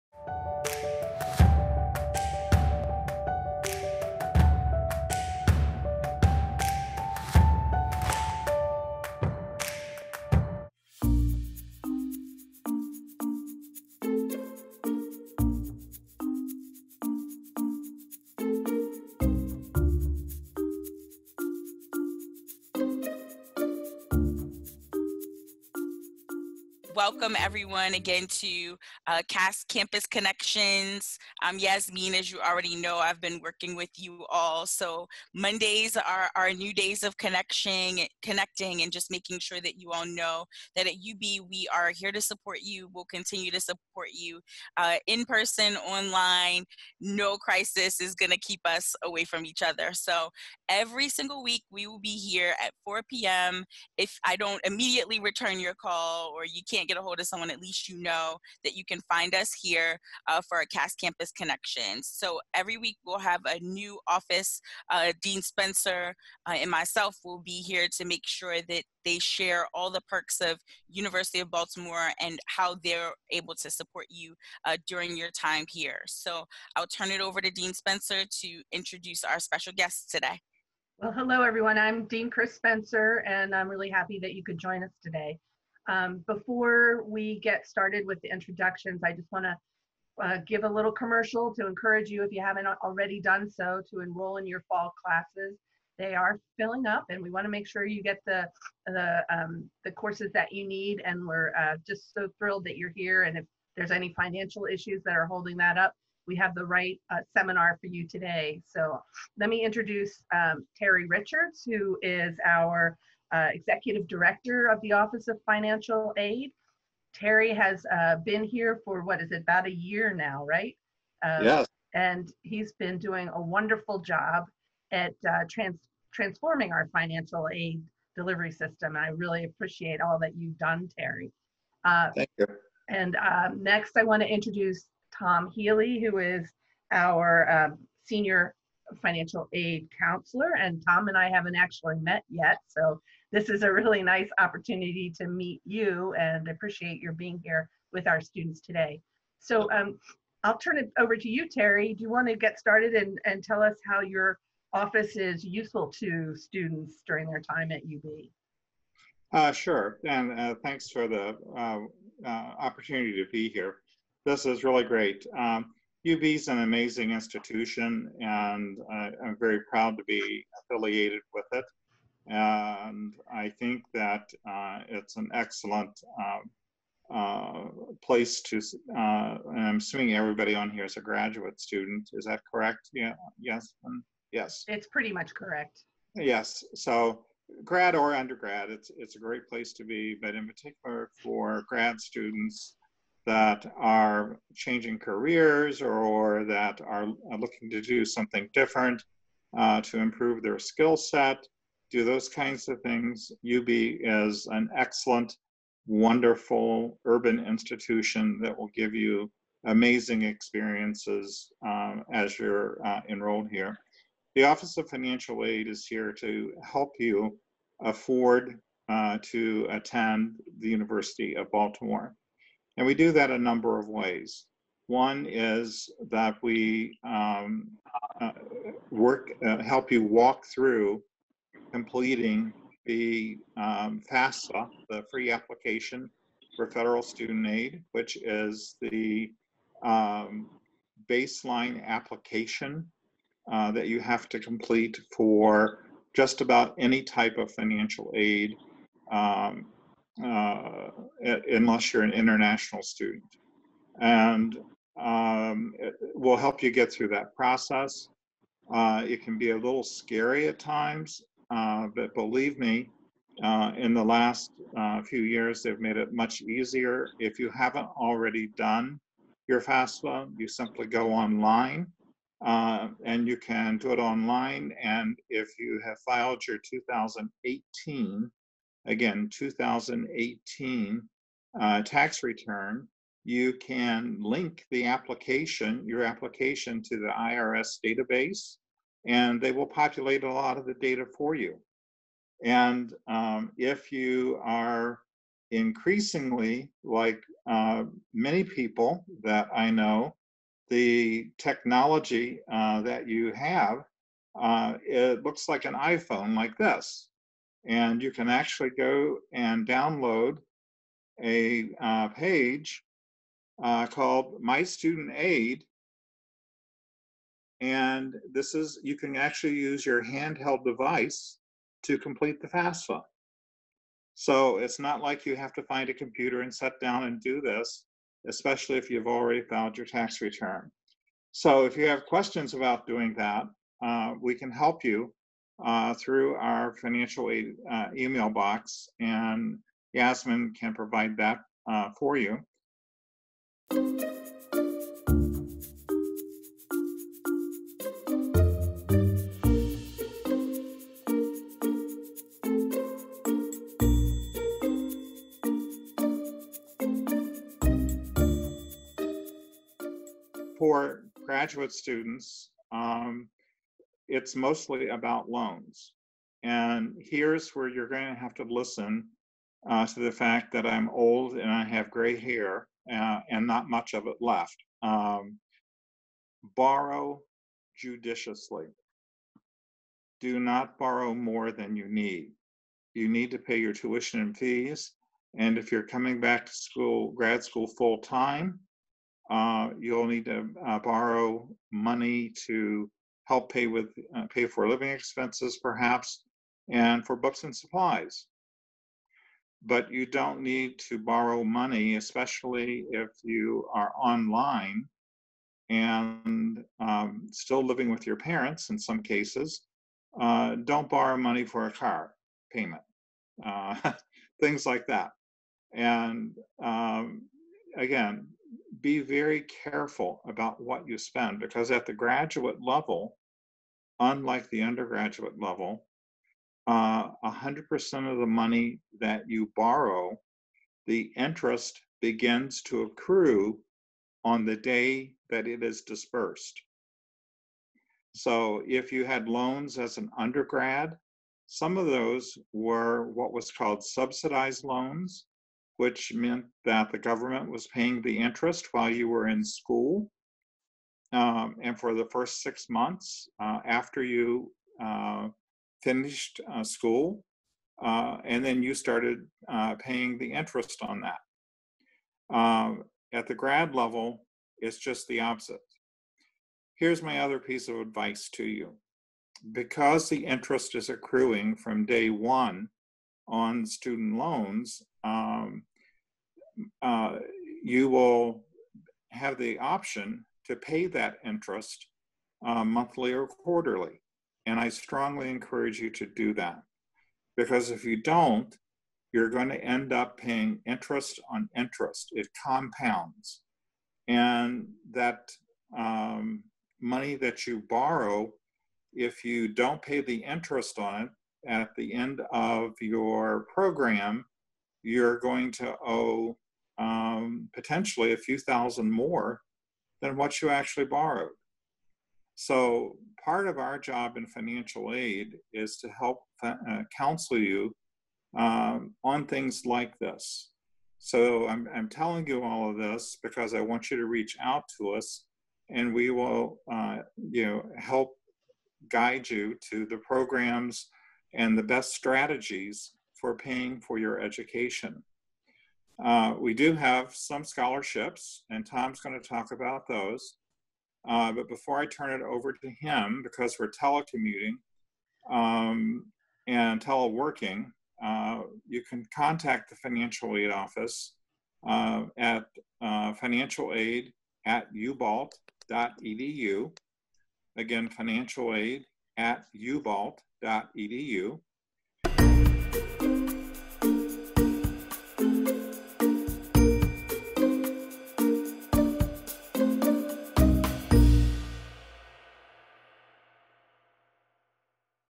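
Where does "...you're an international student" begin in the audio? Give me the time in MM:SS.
04:11.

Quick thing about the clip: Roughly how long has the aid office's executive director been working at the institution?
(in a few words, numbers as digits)
about a year.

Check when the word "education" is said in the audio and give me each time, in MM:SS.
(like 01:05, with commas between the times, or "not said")
08:54.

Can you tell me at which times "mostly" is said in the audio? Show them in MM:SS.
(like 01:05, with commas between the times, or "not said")
06:04.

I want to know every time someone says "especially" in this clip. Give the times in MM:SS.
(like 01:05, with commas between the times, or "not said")
05:28, 06:41.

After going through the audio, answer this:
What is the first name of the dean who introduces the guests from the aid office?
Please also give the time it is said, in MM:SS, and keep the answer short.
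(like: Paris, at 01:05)
Chris, at 01:22.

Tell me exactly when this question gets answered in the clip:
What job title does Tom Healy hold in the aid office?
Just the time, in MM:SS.
02:18.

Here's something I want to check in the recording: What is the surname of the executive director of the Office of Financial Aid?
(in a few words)
Richards.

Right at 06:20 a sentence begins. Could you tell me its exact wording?
Do not borrow more than you need.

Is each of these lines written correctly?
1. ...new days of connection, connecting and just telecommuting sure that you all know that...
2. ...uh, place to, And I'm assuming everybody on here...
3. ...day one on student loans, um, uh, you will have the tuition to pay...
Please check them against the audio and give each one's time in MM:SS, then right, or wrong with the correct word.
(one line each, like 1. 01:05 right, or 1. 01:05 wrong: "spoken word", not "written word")
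1. 00:36 wrong: "making", not "telecommuting"
2. 02:57 right
3. 07:51 wrong: "option", not "tuition".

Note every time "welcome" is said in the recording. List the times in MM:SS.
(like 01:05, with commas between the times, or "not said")
00:27.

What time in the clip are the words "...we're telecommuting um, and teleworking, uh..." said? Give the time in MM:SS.
09:03.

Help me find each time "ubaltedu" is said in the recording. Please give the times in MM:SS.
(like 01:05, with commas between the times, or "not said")
09:14, 09:19.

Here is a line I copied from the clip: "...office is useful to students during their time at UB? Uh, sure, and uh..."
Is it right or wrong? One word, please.
right.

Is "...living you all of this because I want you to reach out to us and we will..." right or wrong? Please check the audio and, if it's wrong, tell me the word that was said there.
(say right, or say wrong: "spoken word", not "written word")
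wrong: "telling", not "living".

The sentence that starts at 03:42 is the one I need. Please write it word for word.
And we do that a number of ways.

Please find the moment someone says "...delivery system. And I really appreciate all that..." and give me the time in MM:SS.
02:08.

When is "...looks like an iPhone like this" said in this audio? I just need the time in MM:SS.
05:05.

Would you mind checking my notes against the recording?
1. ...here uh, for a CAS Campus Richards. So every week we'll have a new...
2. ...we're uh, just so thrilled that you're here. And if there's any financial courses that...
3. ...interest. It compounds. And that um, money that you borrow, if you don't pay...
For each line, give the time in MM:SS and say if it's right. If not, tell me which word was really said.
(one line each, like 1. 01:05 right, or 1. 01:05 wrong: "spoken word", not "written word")
1. 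00:59 wrong: "Connection", not "Richards"
2. 01:41 wrong: "issues", not "courses"
3. 08:11 right.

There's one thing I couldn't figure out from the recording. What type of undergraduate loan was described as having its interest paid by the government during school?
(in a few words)
subsidized loans.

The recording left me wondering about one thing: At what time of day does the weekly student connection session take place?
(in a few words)
4 p.m.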